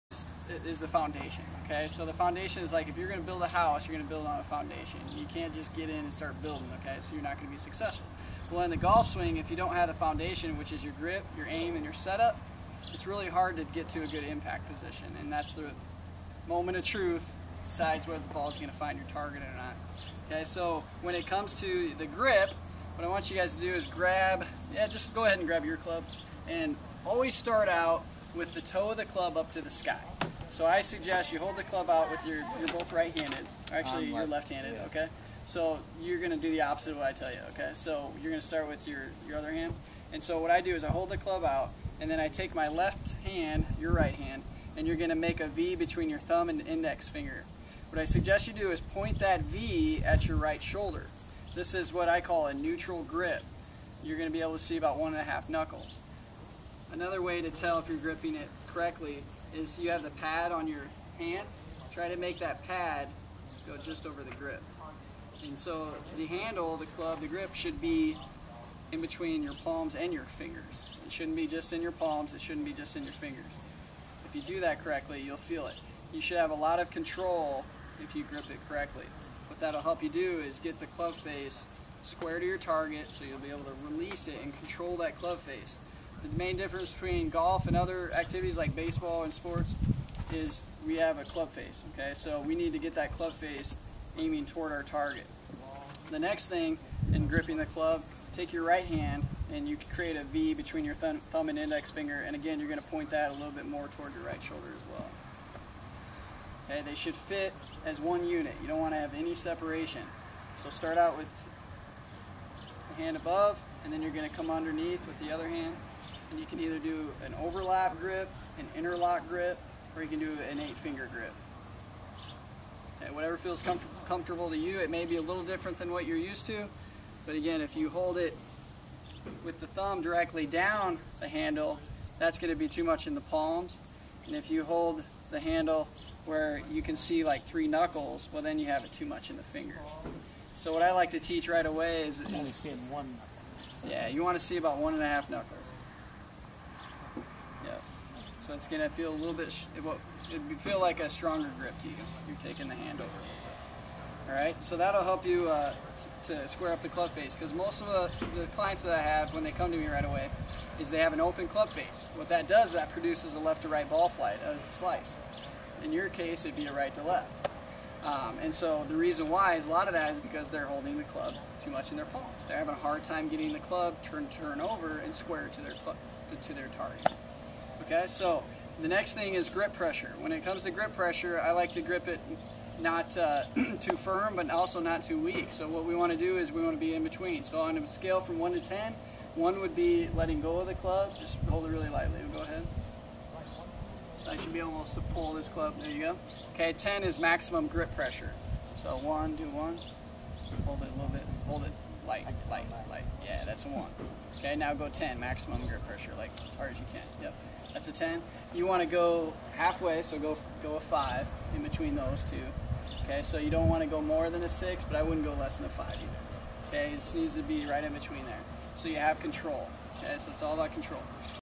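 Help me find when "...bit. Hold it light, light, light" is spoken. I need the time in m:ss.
3:21.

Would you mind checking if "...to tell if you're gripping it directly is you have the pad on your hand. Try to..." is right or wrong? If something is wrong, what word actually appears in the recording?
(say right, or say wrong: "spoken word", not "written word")
wrong: "correctly", not "directly".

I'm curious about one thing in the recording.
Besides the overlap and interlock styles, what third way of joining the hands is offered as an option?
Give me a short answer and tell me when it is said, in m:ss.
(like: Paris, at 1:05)
eight finger grip, at 2:00.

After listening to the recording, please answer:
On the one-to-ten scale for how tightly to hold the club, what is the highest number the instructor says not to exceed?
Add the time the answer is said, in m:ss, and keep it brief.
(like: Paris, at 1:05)
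6, at 3:34.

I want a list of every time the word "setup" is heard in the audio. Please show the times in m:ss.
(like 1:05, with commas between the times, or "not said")
0:11.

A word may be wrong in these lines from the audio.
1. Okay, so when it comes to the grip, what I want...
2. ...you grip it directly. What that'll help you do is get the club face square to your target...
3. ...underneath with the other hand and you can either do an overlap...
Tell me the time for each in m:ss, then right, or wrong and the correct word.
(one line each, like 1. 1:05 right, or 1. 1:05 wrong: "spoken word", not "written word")
1. 0:20 right
2. 1:18 wrong: "correctly", not "directly"
3. 1:54 right.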